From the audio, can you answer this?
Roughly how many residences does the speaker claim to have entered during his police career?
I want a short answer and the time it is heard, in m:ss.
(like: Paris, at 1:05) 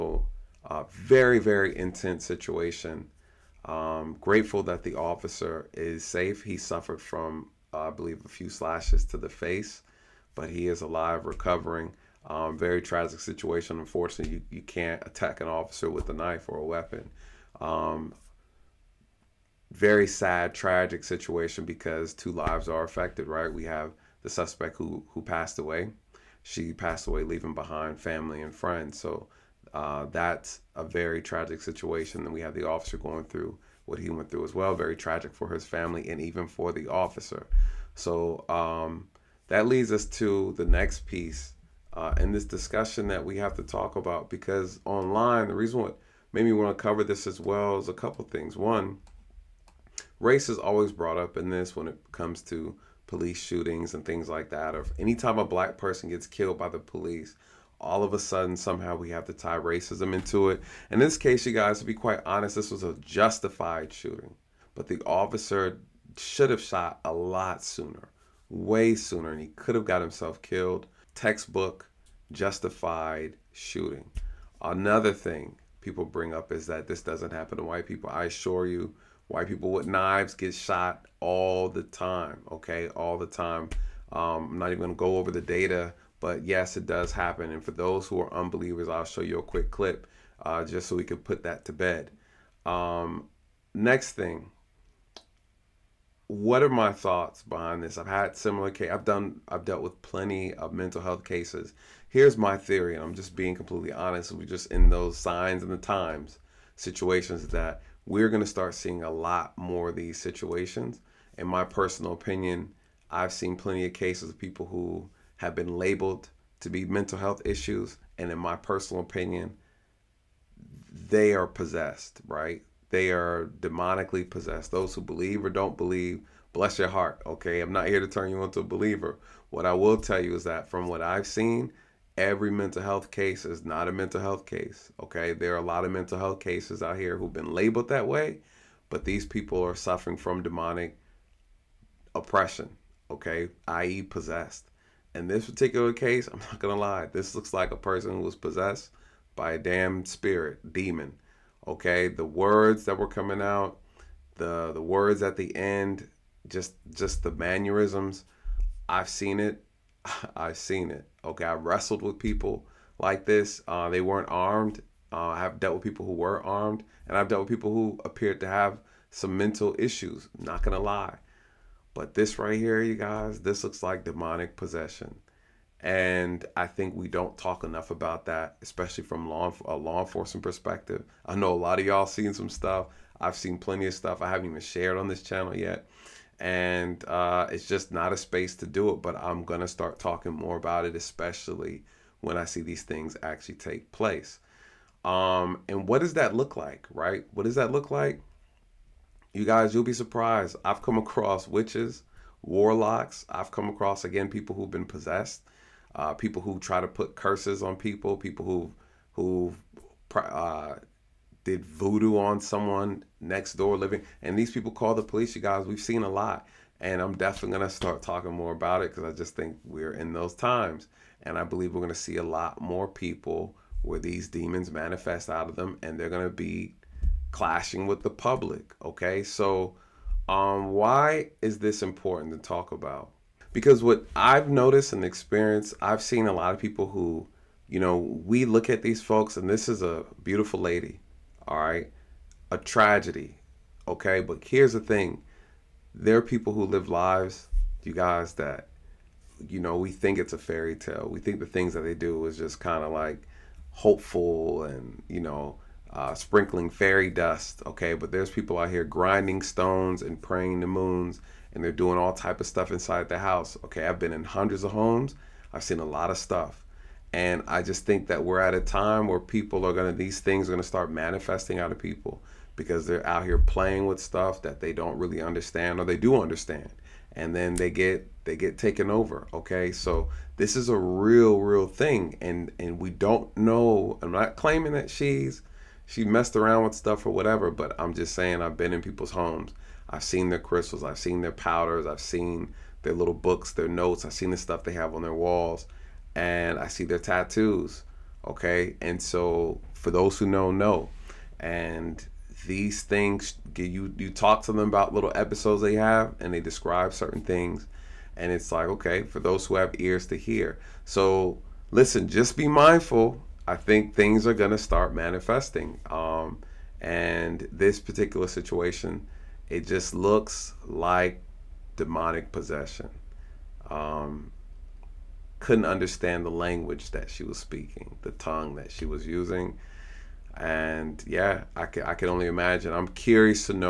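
Hundreds, at 4:24.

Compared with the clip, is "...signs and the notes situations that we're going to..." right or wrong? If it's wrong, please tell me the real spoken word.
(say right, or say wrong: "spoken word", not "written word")
wrong: "times", not "notes".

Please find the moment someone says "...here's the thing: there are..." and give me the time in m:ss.
4:04.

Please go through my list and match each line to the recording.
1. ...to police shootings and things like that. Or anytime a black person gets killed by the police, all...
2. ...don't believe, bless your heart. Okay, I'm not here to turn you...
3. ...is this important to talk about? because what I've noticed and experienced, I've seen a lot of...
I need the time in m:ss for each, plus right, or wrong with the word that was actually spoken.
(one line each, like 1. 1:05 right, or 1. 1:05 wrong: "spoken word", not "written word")
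1. 0:52 right
2. 2:05 right
3. 3:51 right.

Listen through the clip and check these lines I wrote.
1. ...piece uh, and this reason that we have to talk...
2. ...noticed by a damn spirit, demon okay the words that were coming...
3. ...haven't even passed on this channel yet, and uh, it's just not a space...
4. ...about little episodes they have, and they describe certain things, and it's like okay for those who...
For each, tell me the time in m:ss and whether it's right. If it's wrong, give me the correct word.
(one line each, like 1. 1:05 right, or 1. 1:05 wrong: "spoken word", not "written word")
1. 0:41 wrong: "discussion", not "reason"
2. 2:28 wrong: "possessed", not "noticed"
3. 3:04 wrong: "shared", not "passed"
4. 5:04 right.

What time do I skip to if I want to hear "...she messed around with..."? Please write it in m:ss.
4:45.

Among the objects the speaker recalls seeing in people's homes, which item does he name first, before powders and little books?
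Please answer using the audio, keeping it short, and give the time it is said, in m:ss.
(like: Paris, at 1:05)
Crystals, at 4:50.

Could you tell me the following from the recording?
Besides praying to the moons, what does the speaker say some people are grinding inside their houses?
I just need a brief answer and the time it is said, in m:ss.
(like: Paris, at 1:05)
Stones, at 4:19.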